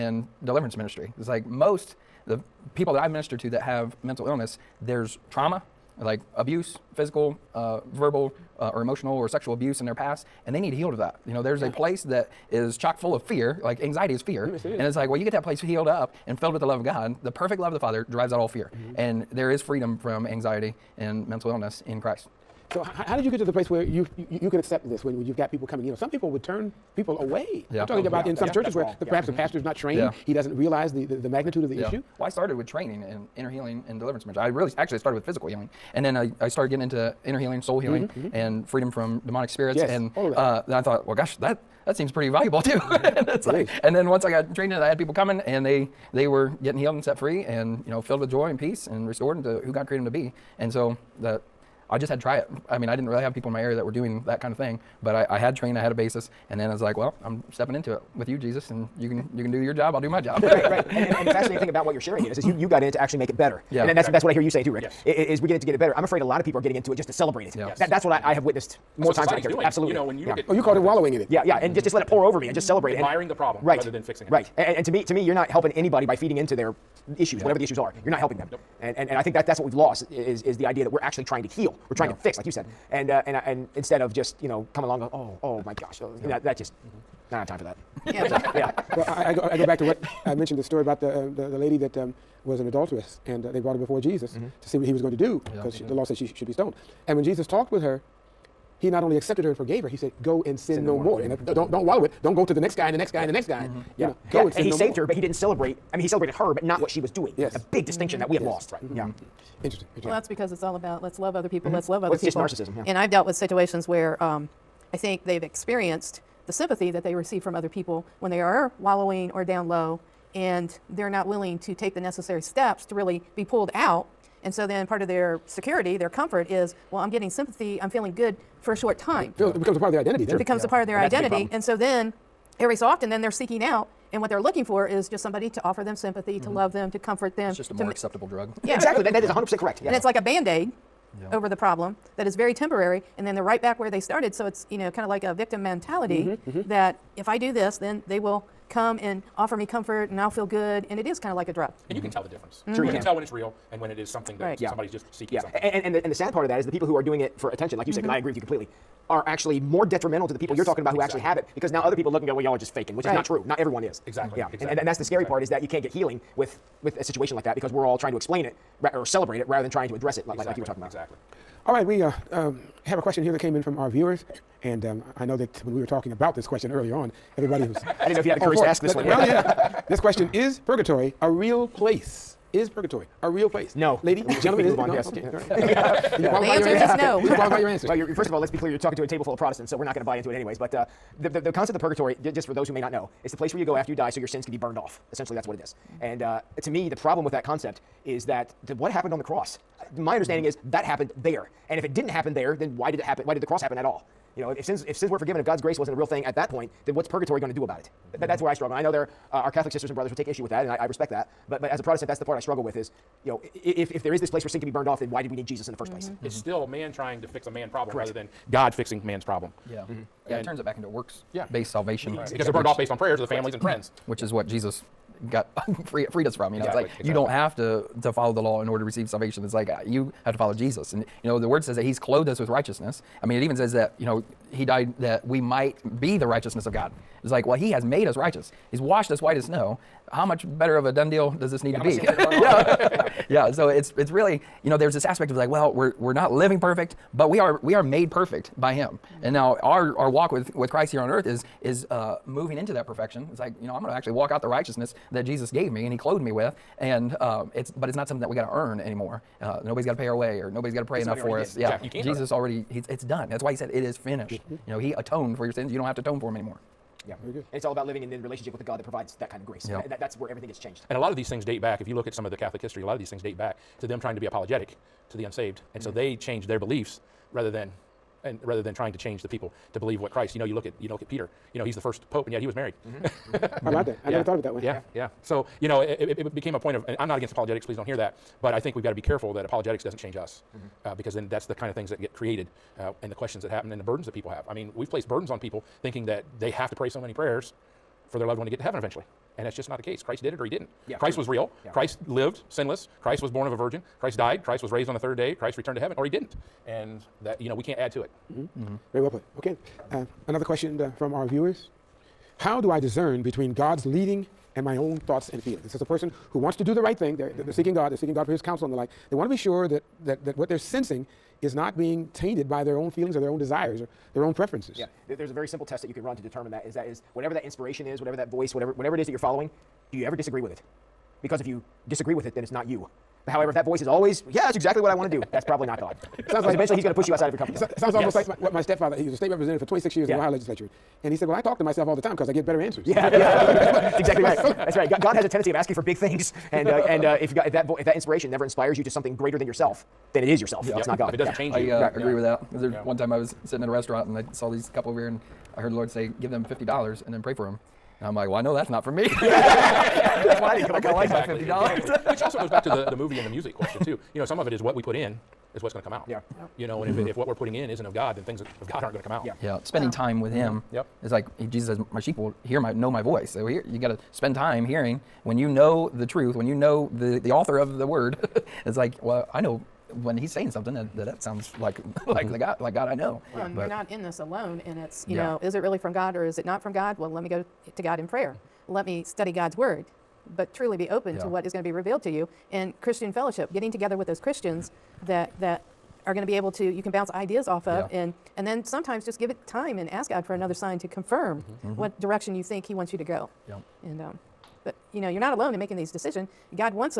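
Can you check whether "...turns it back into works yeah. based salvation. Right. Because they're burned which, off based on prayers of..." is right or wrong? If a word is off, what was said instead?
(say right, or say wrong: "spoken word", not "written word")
right.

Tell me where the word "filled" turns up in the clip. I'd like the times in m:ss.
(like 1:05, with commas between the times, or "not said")
0:16, 0:48.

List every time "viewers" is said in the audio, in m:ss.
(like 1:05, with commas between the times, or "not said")
2:53, 5:11.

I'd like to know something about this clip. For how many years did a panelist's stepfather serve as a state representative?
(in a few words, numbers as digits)
26.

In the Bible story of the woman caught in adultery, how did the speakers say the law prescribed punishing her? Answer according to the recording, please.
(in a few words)
Stoned.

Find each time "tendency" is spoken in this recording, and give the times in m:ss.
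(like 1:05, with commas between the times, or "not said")
5:45.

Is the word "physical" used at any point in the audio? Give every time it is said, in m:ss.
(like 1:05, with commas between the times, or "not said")
0:06, 0:35.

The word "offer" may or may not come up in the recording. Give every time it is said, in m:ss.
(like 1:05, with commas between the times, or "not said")
2:15, 2:29.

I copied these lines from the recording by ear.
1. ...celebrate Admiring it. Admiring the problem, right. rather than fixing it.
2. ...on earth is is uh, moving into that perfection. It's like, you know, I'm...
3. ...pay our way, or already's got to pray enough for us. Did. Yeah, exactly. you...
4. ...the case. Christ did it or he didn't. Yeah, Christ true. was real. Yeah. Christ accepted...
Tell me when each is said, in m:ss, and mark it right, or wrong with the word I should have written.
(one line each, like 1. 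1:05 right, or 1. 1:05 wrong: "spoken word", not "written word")
1. 1:12 right
2. 4:10 right
3. 4:19 wrong: "nobody", not "already"
4. 4:59 wrong: "lived", not "accepted".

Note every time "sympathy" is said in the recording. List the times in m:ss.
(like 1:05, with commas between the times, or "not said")
1:56, 2:07, 2:15.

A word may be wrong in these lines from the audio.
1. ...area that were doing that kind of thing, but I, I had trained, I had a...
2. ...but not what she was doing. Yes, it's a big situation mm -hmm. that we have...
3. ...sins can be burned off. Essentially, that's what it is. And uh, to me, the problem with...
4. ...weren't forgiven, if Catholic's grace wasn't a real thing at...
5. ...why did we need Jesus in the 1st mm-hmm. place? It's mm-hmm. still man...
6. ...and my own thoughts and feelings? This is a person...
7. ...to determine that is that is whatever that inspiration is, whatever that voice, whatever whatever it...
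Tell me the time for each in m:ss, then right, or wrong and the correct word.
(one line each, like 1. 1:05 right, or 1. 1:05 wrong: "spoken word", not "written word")
1. 0:53 right
2. 1:46 wrong: "distinction", not "situation"
3. 3:14 right
4. 3:25 wrong: "God", not "Catholic"
5. 3:35 right
6. 5:14 right
7. 5:26 right.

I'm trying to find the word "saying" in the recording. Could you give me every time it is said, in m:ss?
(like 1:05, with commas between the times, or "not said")
1:04, 6:20.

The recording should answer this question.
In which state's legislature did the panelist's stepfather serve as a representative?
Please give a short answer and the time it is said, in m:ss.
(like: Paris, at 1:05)
Ohio, at 5:40.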